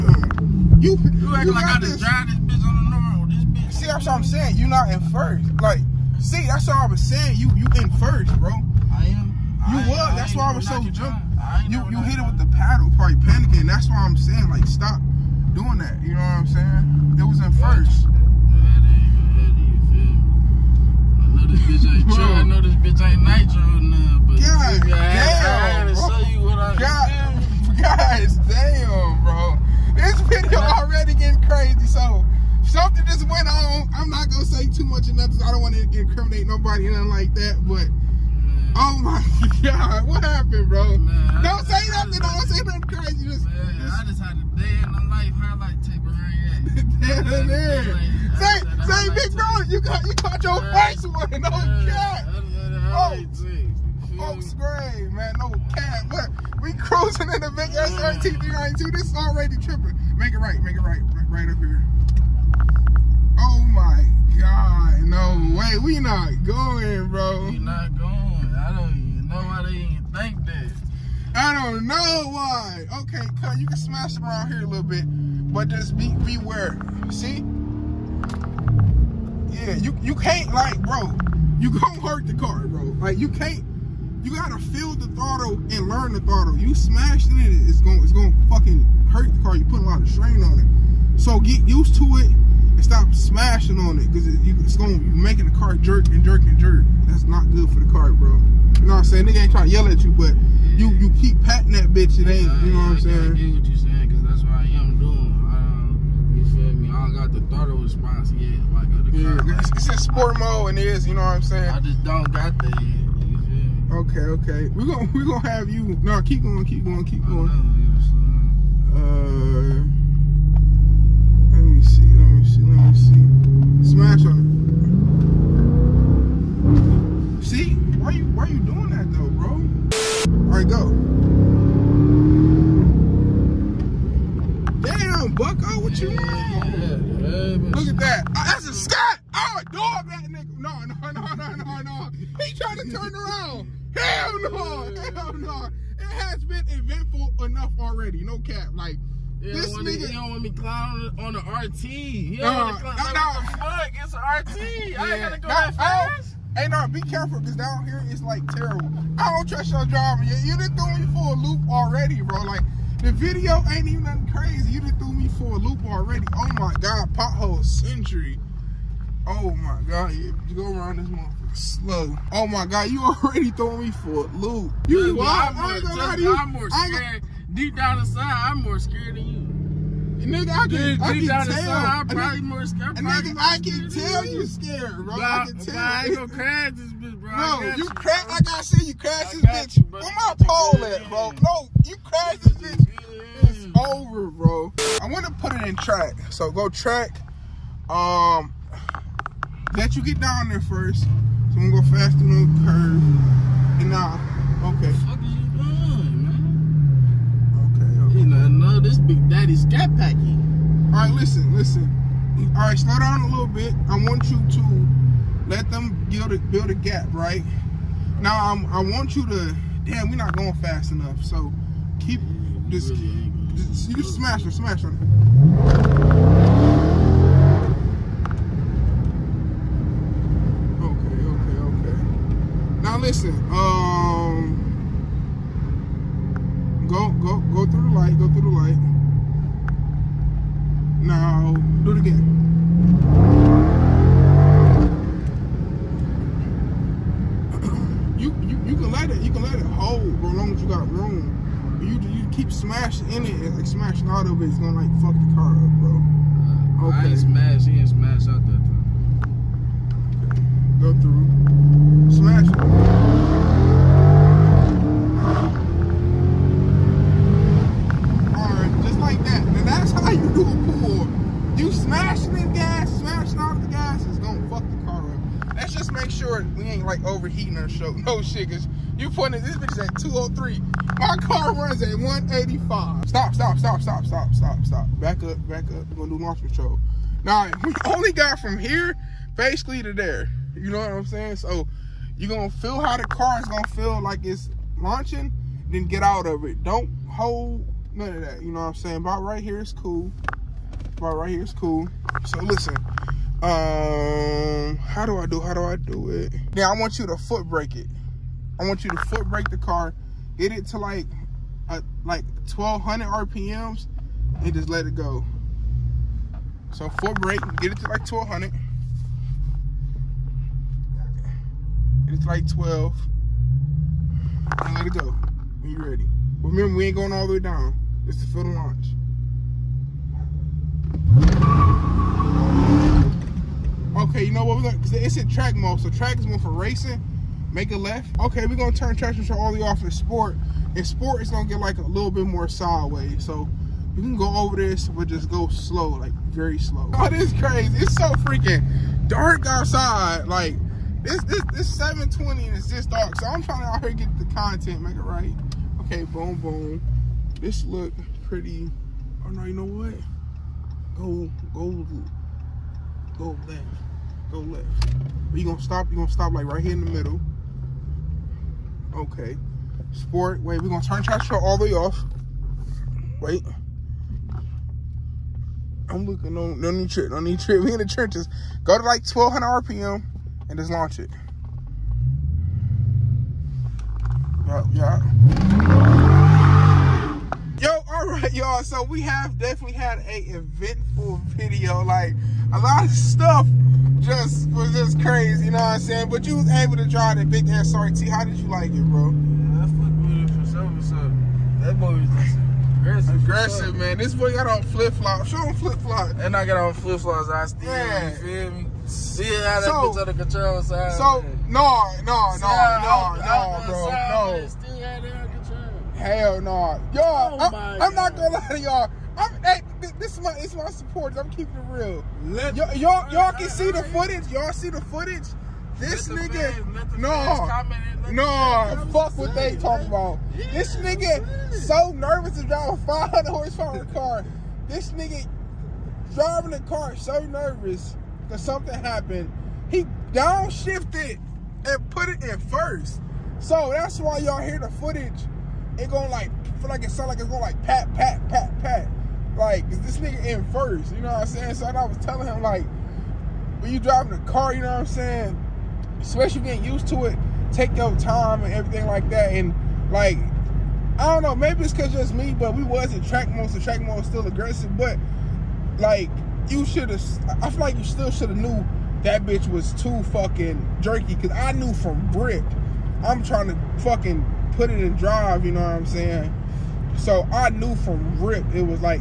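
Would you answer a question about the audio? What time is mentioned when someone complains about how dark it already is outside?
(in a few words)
720.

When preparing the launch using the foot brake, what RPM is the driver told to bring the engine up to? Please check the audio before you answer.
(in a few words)
1200.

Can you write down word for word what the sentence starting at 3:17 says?
Um, let you get down there first.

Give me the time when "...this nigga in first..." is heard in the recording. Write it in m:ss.
7:29.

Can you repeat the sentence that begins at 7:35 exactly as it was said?
Especially getting used to it, take your time and everything like that.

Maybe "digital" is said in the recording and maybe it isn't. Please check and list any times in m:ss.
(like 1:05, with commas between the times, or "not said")
not said.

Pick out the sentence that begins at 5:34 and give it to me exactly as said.
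We're it's in track mode, so track is more for racing make a left.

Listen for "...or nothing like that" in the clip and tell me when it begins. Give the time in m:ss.
0:36.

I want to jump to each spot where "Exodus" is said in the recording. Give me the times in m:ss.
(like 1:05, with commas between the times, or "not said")
not said.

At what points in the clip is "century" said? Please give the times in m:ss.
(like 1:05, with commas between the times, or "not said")
2:47.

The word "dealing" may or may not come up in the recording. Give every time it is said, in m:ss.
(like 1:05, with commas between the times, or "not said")
not said.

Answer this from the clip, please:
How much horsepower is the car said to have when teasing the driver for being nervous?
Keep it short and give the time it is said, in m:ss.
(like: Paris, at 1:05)
500, at 7:12.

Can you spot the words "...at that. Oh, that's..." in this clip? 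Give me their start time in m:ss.
2:17.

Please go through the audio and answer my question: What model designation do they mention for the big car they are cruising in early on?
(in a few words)
SRT 392.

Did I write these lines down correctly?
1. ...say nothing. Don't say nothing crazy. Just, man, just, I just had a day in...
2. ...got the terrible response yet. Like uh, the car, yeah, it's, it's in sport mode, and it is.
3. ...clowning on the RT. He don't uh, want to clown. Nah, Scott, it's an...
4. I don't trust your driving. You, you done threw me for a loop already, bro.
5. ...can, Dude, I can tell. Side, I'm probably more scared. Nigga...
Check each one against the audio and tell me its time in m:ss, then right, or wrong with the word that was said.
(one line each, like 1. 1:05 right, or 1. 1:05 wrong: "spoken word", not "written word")
1. 0:41 right
2. 1:47 wrong: "throttle", not "terrible"
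3. 2:30 wrong: "Fuck", not "Scott"
4. 2:39 right
5. 3:00 right.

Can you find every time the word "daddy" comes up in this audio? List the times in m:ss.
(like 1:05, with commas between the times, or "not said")
3:29.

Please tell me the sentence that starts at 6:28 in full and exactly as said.
So we have definitely had a eventful video.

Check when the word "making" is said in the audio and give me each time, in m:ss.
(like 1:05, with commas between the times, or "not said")
1:34.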